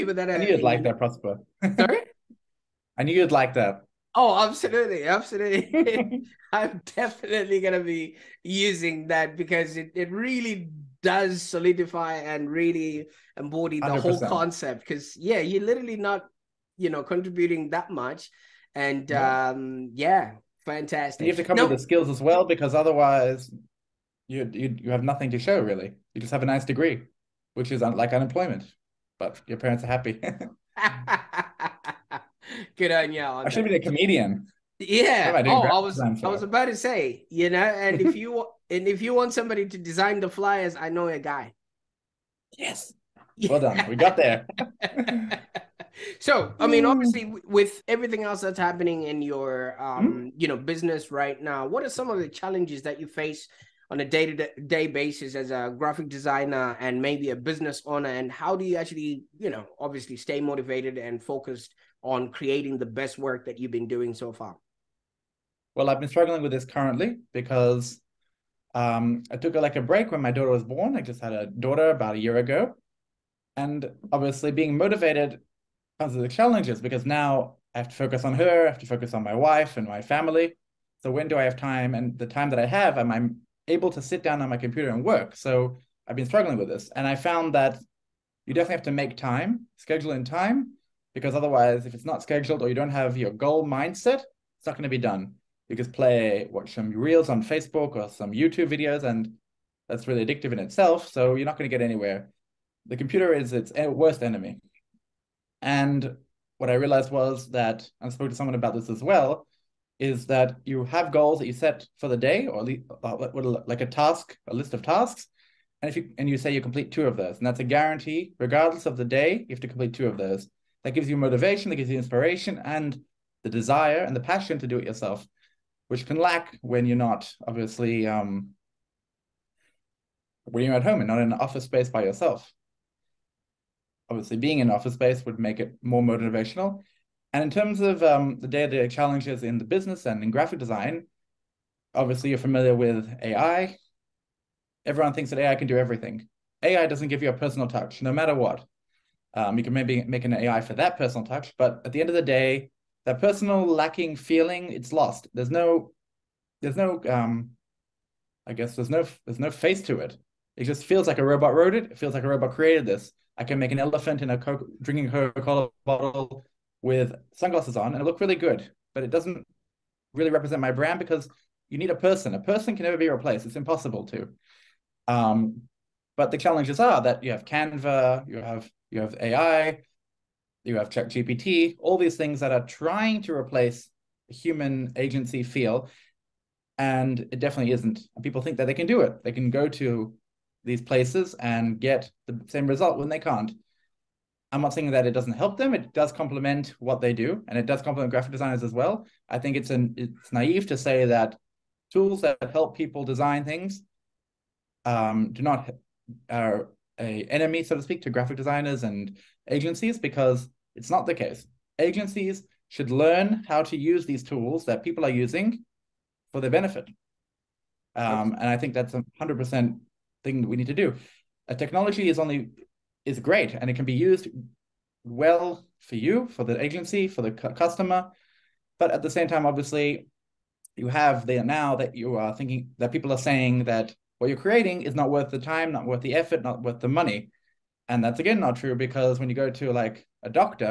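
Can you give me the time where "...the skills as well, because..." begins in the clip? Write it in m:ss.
0:21.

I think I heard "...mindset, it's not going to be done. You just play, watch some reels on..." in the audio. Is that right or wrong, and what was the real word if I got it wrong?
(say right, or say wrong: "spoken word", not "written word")
right.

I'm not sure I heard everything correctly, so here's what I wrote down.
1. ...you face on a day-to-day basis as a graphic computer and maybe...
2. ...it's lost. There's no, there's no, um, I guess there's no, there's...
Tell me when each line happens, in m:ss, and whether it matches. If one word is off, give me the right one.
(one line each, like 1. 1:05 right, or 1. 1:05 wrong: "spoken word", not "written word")
1. 0:52 wrong: "designer", not "computer"
2. 2:34 right.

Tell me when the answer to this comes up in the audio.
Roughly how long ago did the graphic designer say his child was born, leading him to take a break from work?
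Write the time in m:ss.
1:11.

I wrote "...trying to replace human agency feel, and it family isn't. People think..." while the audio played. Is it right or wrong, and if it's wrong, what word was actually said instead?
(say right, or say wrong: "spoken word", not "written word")
wrong: "definitely", not "family".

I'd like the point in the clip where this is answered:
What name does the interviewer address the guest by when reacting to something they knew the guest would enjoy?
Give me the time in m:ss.
0:00.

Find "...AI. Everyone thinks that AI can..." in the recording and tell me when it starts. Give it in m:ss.
2:23.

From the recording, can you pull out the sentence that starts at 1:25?
So I've been struggling with this.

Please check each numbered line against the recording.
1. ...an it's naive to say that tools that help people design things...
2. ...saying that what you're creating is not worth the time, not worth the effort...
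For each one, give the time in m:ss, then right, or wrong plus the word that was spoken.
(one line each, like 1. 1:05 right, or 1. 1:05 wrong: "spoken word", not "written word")
1. 3:19 right
2. 3:53 right.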